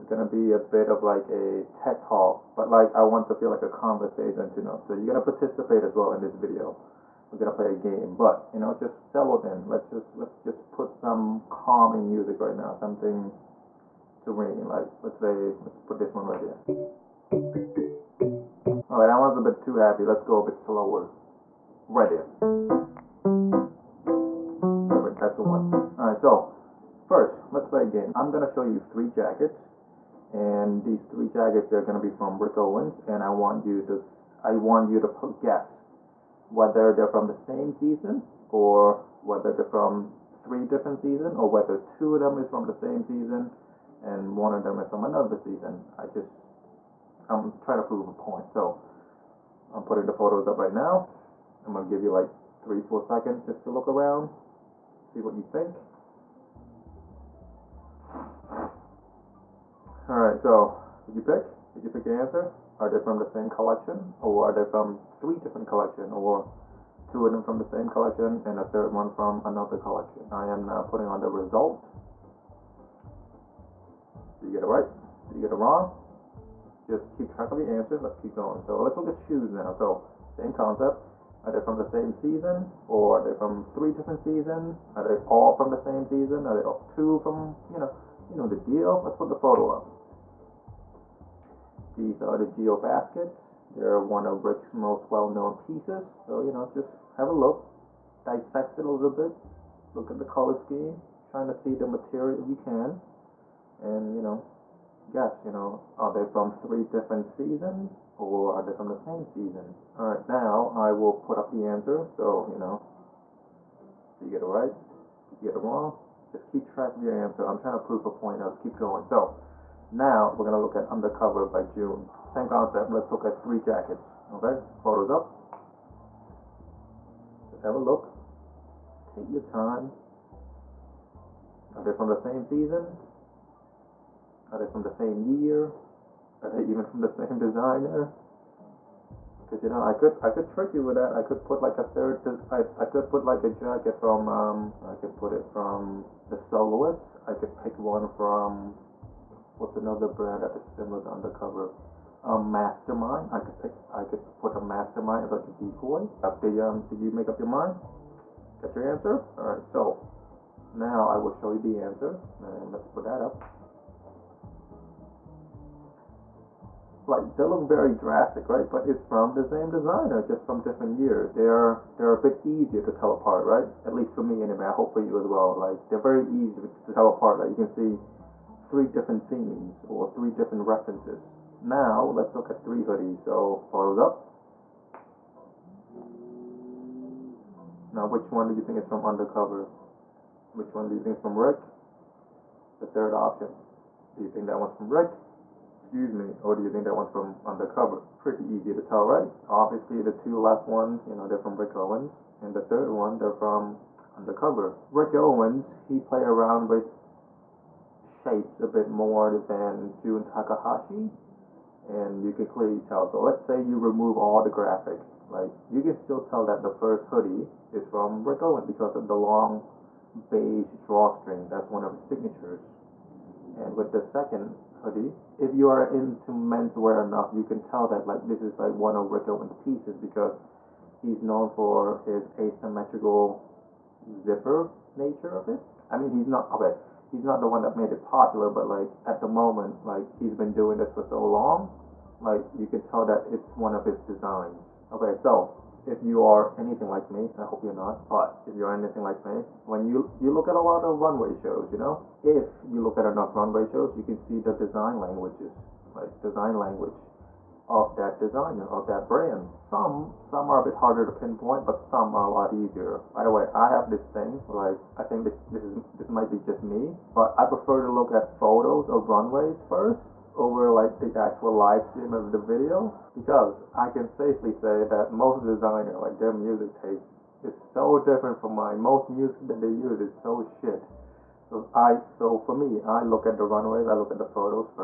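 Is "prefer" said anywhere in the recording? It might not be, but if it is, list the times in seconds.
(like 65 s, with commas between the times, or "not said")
267 s.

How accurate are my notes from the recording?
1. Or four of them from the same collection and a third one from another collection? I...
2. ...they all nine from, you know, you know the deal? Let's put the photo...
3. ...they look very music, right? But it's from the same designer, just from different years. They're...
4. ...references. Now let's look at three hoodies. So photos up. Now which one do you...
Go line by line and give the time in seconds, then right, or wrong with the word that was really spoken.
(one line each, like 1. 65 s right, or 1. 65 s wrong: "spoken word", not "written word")
1. 66 s wrong: "two", not "four"
2. 86 s wrong: "two", not "nine"
3. 167 s wrong: "drastic", not "music"
4. 180 s right.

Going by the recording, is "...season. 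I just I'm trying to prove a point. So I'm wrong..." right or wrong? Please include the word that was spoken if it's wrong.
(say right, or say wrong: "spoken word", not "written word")
wrong: "putting", not "wrong".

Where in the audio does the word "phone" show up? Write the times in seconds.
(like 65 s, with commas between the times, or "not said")
not said.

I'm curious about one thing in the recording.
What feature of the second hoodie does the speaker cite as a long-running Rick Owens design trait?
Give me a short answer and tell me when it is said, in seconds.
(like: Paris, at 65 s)
Asymmetrical zipper, at 232 s.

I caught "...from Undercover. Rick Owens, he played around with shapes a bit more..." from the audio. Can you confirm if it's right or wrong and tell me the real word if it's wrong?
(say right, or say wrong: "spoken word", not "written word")
right.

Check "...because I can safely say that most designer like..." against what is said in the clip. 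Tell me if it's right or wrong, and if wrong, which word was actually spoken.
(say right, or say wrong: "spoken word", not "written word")
right.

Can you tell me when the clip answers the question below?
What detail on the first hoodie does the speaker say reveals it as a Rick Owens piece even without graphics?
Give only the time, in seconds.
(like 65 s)
219 s.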